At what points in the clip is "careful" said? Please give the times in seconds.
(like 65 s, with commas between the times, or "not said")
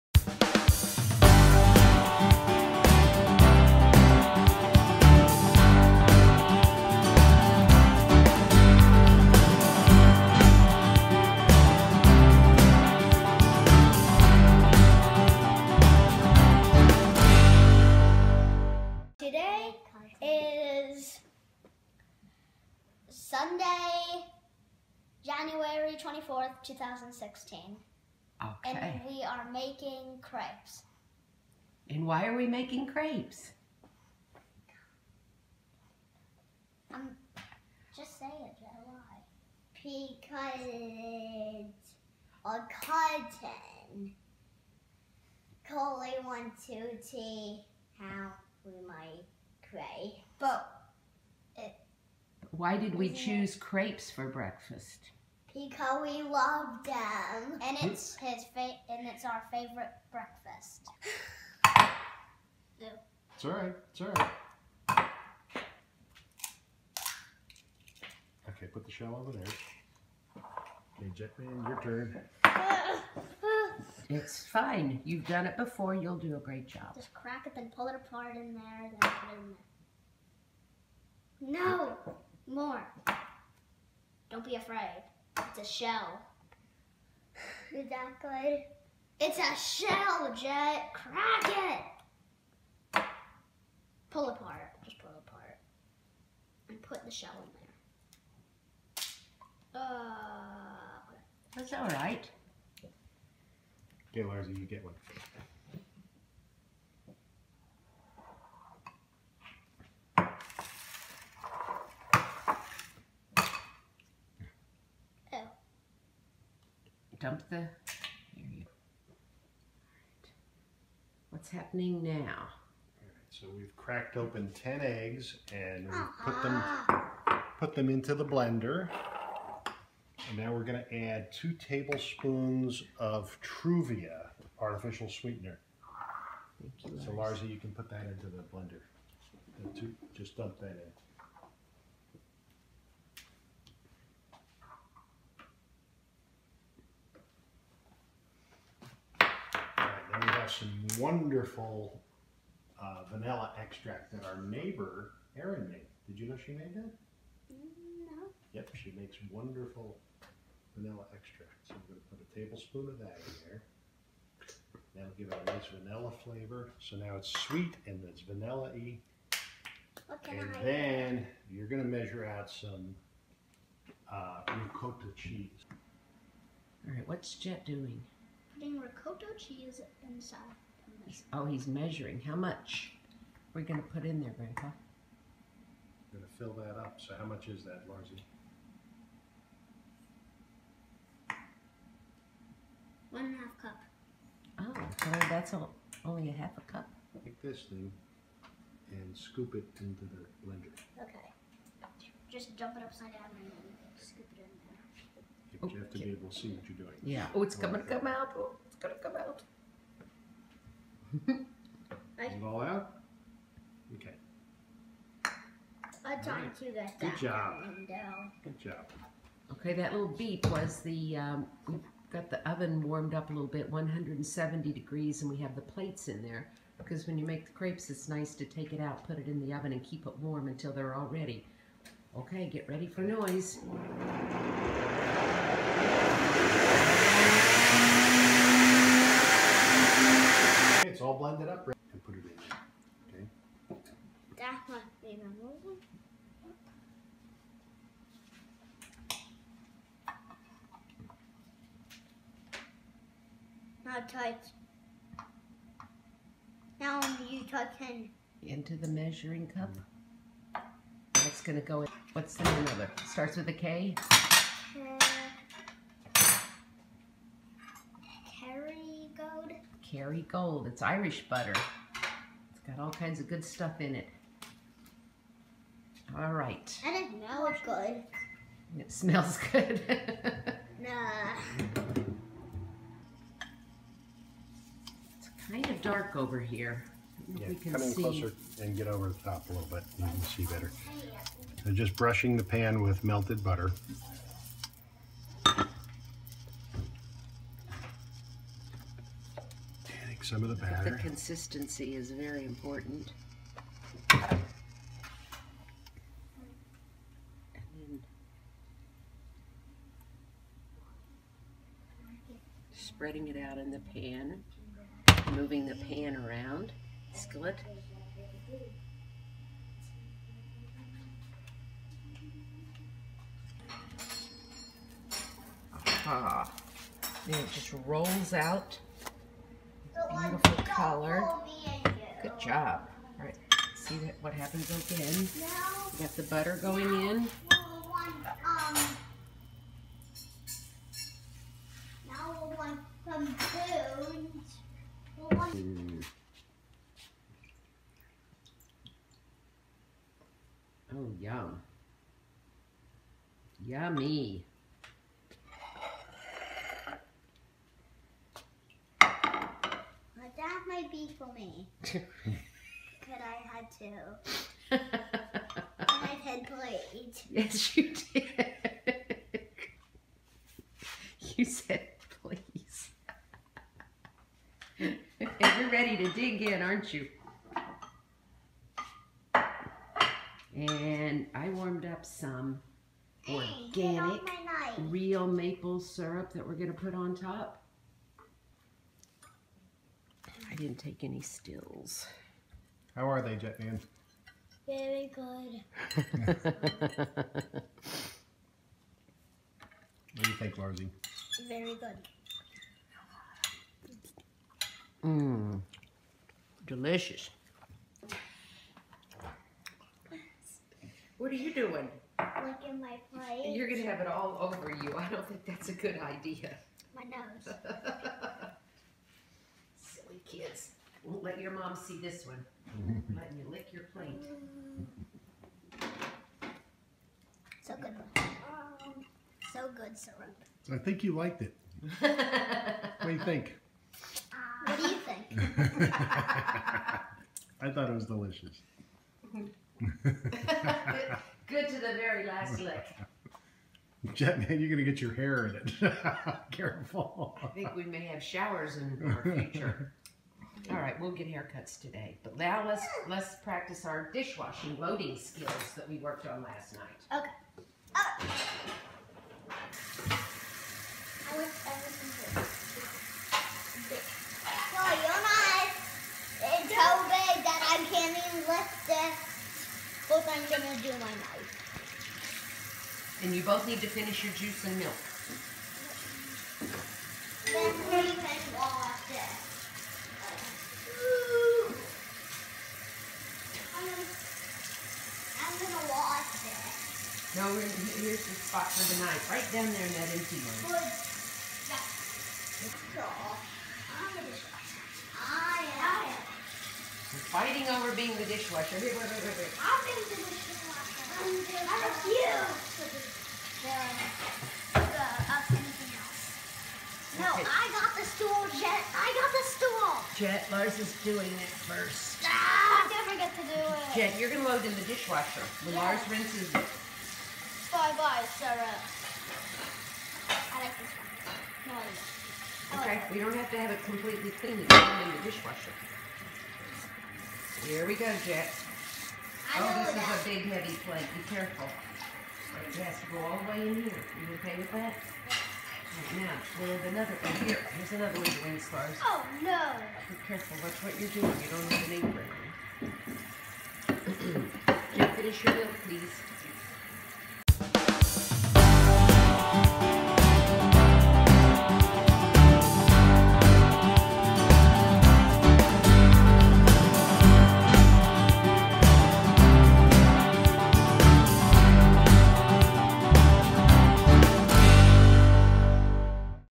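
446 s, 531 s, 540 s.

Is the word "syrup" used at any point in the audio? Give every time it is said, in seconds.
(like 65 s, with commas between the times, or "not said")
385 s, 429 s.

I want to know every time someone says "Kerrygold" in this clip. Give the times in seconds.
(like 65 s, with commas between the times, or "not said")
269 s.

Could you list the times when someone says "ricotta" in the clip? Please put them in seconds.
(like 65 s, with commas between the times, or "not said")
174 s, 178 s.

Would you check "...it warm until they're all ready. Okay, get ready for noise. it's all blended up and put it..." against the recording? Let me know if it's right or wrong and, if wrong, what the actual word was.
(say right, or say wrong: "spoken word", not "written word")
right.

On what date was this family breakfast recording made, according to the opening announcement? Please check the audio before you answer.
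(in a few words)
Sunday, January 24th, 2016.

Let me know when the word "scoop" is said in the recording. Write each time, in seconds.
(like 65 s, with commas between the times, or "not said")
199 s, 203 s.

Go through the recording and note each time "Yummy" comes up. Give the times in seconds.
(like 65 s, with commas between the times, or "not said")
353 s.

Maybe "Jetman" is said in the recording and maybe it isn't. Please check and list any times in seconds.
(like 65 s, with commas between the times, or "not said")
71 s, 393 s, 444 s.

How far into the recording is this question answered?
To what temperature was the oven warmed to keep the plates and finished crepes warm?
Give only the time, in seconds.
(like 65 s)
223 s.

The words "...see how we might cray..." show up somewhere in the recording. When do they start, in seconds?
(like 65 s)
47 s.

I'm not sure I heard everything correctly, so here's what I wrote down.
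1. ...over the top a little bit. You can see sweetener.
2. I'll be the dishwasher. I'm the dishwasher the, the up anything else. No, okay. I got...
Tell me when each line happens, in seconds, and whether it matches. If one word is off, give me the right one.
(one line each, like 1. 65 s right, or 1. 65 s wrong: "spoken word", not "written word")
1. 288 s wrong: "better", not "sweetener"
2. 499 s right.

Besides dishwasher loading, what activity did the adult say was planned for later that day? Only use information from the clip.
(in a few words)
Haircuts.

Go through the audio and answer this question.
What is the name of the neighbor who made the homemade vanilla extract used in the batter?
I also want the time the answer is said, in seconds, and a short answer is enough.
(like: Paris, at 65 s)
Erin, at 155 s.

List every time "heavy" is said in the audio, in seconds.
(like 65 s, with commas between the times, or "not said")
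530 s.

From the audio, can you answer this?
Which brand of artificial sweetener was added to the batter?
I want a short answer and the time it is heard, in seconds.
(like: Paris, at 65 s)
Truvia, at 133 s.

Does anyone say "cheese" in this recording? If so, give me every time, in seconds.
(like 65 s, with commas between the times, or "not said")
175 s, 179 s.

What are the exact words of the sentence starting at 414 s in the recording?
I don't think that's a good idea.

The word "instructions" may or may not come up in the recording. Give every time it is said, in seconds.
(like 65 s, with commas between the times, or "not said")
not said.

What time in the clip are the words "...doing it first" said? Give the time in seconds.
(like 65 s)
511 s.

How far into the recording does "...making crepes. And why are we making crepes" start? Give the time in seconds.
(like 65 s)
29 s.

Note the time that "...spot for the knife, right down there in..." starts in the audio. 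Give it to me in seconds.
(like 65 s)
488 s.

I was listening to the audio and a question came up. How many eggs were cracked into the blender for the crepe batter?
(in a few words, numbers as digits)
10.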